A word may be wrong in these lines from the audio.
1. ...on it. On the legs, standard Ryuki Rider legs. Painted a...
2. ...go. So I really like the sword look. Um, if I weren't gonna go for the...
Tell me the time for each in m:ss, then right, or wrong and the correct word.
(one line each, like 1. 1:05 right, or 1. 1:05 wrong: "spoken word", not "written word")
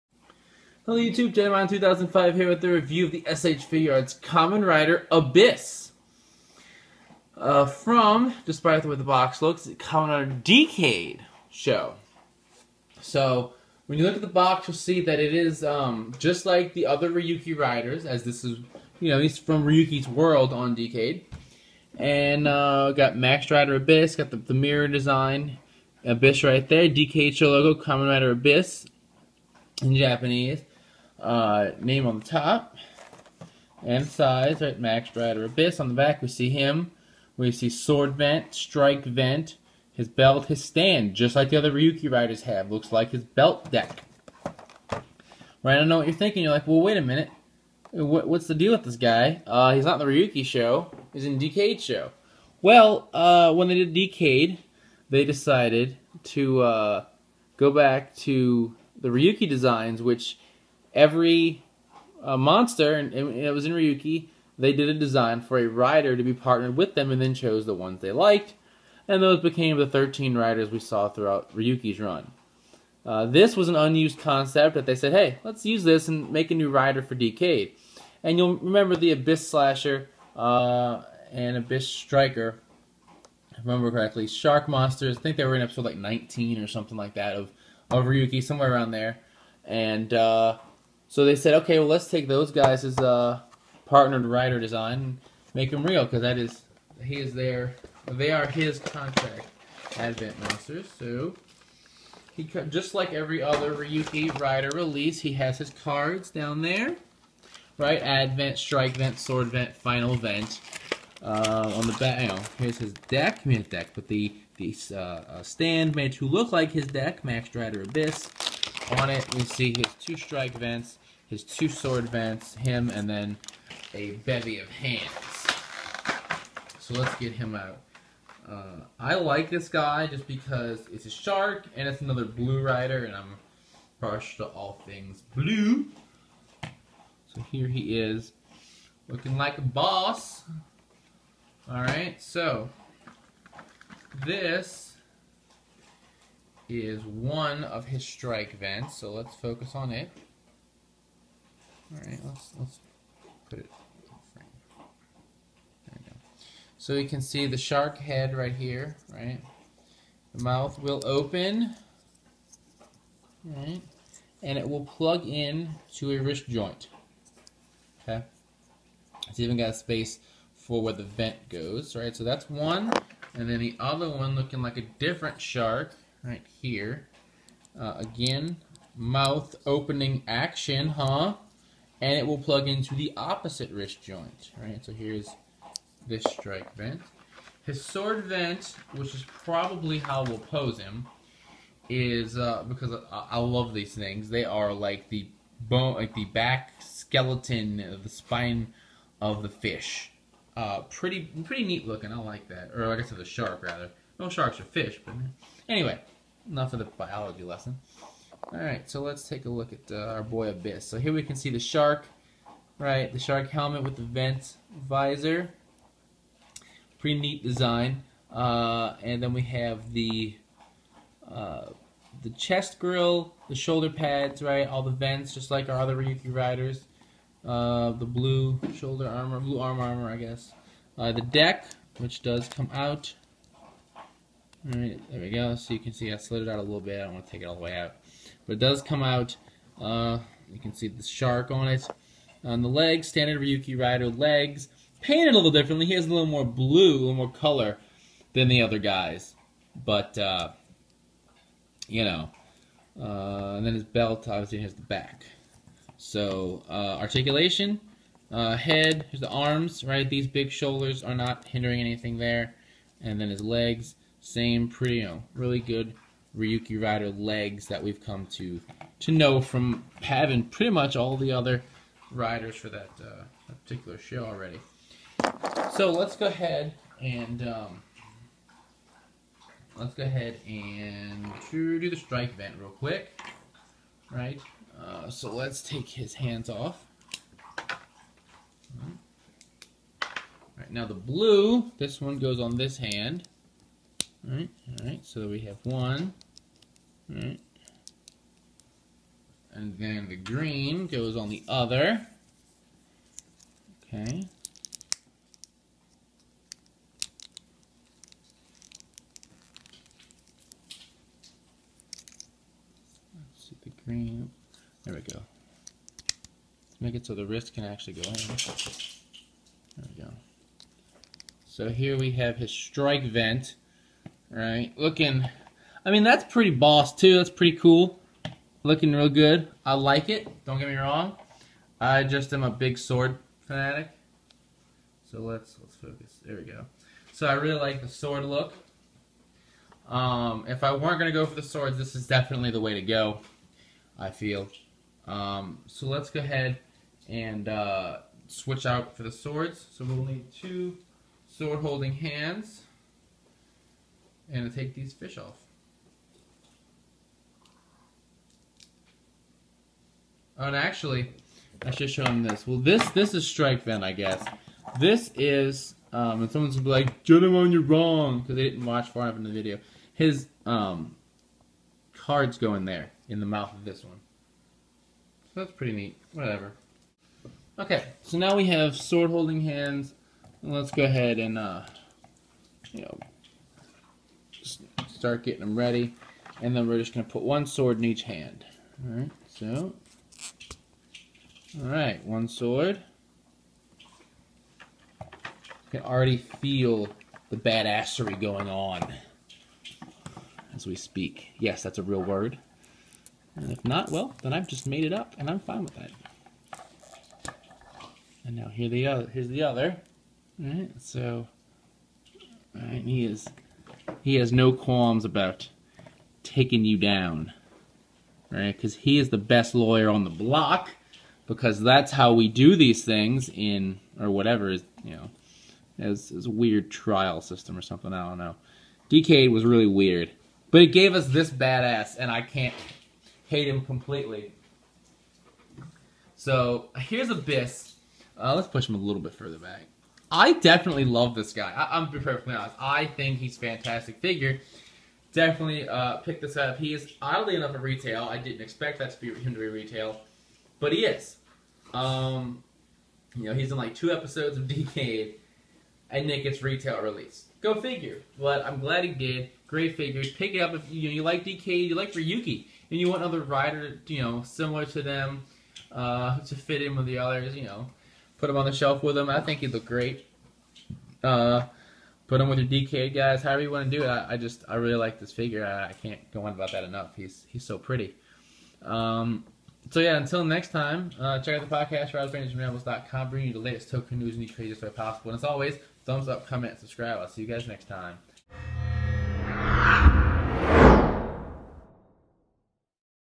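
1. 4:01 right
2. 5:36 right.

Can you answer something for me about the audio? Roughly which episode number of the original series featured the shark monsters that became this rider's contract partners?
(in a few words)
19.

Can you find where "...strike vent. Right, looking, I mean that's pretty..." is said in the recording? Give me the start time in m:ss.
5:22.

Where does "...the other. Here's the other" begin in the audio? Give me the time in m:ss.
6:48.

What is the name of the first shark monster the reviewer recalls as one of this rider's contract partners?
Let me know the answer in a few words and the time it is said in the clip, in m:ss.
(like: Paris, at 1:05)
Abyss Slasher, at 1:19.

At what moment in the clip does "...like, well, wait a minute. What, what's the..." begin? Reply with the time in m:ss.
0:46.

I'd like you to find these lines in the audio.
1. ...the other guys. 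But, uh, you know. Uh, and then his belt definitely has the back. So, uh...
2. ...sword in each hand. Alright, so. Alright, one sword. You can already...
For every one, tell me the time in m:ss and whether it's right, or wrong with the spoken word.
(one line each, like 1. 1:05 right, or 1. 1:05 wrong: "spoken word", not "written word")
1. 4:08 wrong: "obviously", not "definitely"
2. 6:27 right.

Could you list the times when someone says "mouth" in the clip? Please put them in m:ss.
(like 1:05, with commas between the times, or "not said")
2:40, 2:58, 6:13.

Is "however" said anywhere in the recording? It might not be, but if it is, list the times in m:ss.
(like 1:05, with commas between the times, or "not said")
7:53.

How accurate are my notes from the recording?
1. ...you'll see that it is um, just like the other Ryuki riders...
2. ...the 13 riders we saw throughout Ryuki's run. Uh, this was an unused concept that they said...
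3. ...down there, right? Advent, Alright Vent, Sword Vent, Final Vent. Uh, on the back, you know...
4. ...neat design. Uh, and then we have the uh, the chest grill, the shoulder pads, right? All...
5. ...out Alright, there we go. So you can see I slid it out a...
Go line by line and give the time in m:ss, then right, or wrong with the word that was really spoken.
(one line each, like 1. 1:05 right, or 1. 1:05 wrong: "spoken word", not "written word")
1. 0:14 right
2. 1:09 right
3. 1:46 wrong: "Strike", not "Alright"
4. 3:37 right
5. 3:52 right.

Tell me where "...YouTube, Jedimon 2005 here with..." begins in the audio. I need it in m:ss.
0:00.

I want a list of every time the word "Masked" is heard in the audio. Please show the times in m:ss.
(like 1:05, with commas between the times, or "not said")
0:23, 0:34, 1:57.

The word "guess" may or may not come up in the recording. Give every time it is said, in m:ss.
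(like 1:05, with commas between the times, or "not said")
3:50, 6:03.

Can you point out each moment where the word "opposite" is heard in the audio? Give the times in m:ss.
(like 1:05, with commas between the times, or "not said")
3:03.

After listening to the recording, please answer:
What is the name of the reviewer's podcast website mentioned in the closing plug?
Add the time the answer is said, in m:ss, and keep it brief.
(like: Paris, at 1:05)
ridersrangersandrambles.com, at 8:01.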